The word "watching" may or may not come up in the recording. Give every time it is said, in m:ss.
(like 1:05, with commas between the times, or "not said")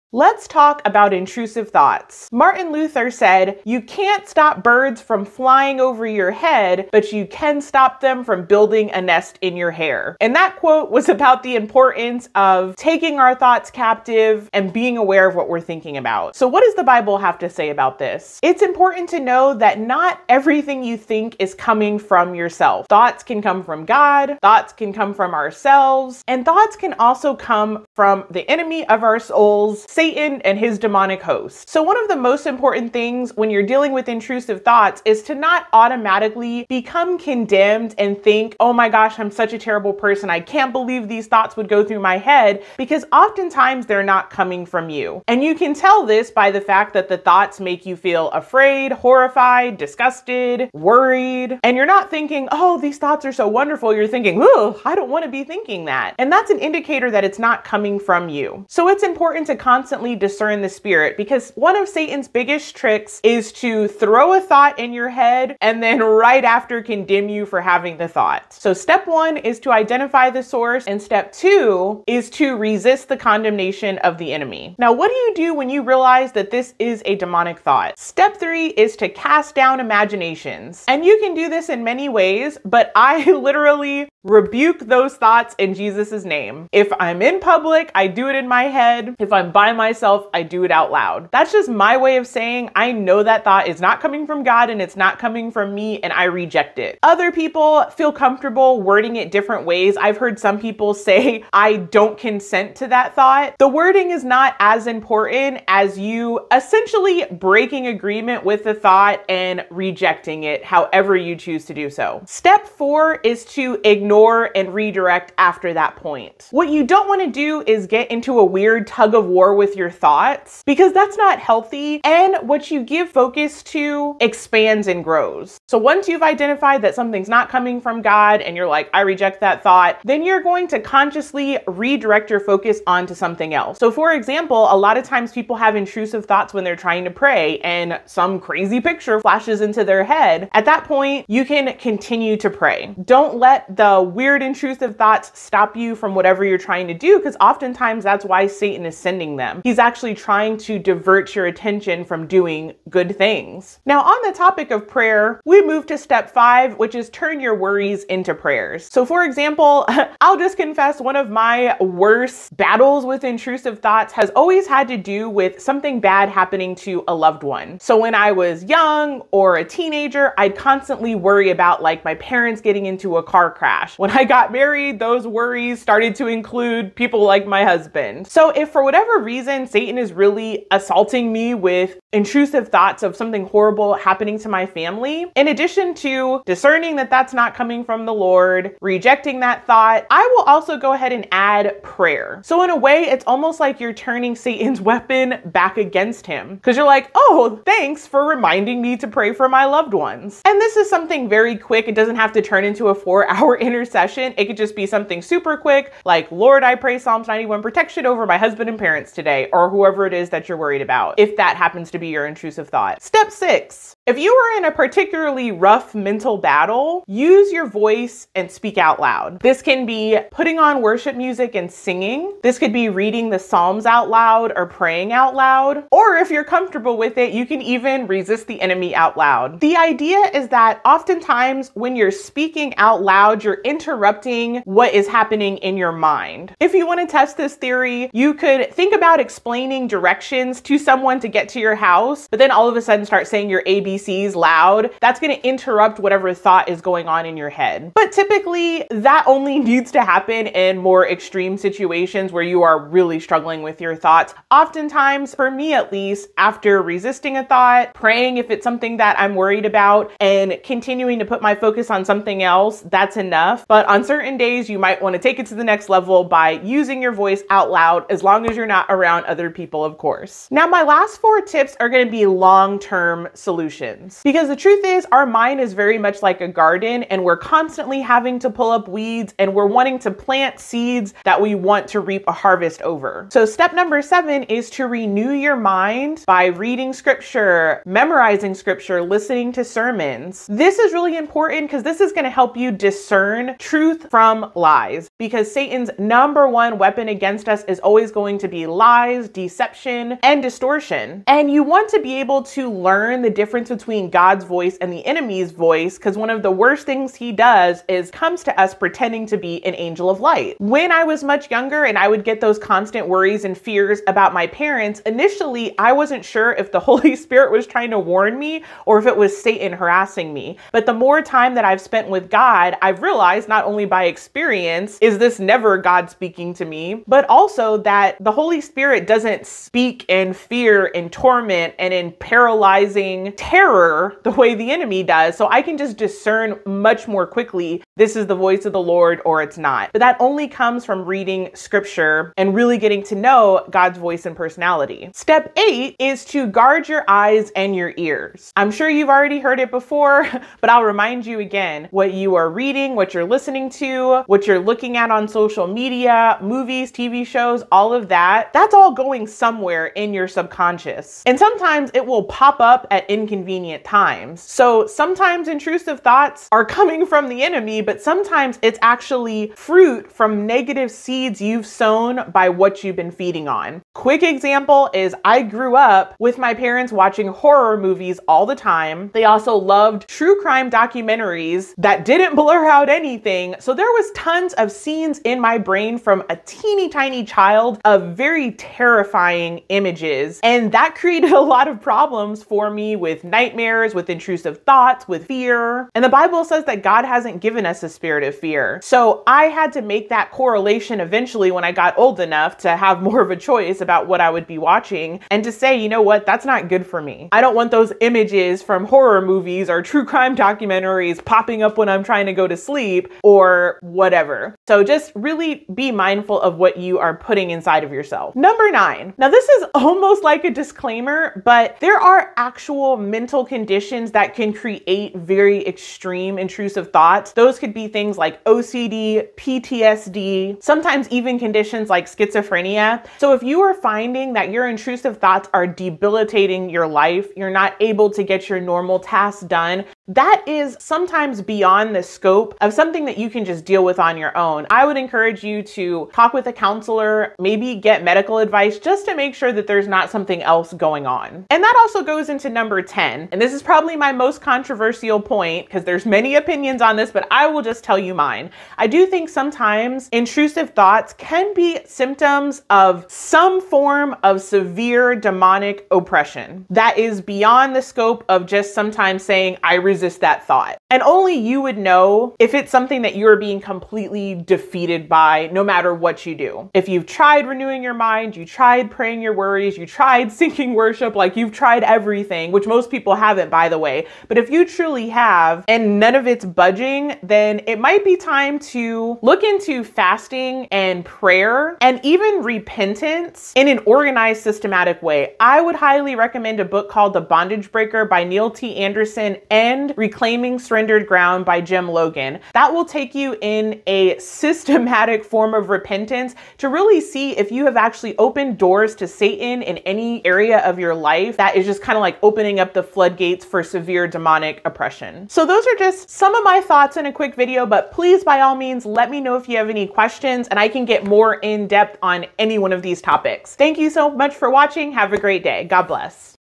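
6:16, 6:44, 8:44.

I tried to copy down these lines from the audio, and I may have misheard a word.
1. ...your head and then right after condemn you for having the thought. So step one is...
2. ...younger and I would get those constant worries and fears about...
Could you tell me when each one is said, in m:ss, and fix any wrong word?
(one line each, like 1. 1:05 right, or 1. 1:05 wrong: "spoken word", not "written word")
1. 1:04 right
2. 5:11 right.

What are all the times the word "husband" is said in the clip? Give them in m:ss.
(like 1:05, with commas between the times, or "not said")
2:57, 3:28.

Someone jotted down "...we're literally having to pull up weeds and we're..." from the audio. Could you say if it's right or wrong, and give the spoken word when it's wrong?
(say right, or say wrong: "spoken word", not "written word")
wrong: "constantly", not "literally".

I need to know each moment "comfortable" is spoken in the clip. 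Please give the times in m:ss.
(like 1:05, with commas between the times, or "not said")
1:38, 3:46.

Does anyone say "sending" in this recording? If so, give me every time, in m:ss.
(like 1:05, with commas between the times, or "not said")
2:28.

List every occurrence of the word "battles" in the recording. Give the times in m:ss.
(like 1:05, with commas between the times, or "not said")
2:42, 3:36.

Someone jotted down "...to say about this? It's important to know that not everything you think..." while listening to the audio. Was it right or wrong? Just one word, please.
right.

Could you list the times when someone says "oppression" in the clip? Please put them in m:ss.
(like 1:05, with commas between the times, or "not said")
7:45, 8:34.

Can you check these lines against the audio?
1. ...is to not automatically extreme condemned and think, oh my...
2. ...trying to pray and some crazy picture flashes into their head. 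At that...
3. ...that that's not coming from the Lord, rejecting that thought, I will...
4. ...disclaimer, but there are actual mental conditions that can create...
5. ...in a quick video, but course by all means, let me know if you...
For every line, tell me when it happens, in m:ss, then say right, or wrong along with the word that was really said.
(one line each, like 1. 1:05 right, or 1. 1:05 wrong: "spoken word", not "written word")
1. 0:35 wrong: "become", not "extreme"
2. 2:16 right
3. 3:06 right
4. 7:00 right
5. 8:36 wrong: "please", not "course".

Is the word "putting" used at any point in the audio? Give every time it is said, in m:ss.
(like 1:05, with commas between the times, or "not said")
3:40, 6:57.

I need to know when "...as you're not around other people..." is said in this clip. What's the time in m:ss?
4:28.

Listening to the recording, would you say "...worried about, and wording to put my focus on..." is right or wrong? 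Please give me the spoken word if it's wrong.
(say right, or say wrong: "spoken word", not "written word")
wrong: "continuing", not "wording".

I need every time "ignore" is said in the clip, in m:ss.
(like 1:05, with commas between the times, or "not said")
1:53.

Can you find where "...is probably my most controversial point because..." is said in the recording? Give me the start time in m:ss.
7:33.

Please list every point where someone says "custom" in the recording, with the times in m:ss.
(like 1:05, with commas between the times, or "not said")
not said.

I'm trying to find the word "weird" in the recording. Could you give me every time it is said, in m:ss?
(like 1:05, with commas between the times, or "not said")
1:58, 2:24.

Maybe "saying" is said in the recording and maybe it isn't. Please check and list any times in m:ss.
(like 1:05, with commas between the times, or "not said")
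1:32, 4:03, 7:49.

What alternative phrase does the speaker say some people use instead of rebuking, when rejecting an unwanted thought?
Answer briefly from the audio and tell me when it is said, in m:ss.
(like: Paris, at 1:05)
I don't consent to that thought, at 1:41.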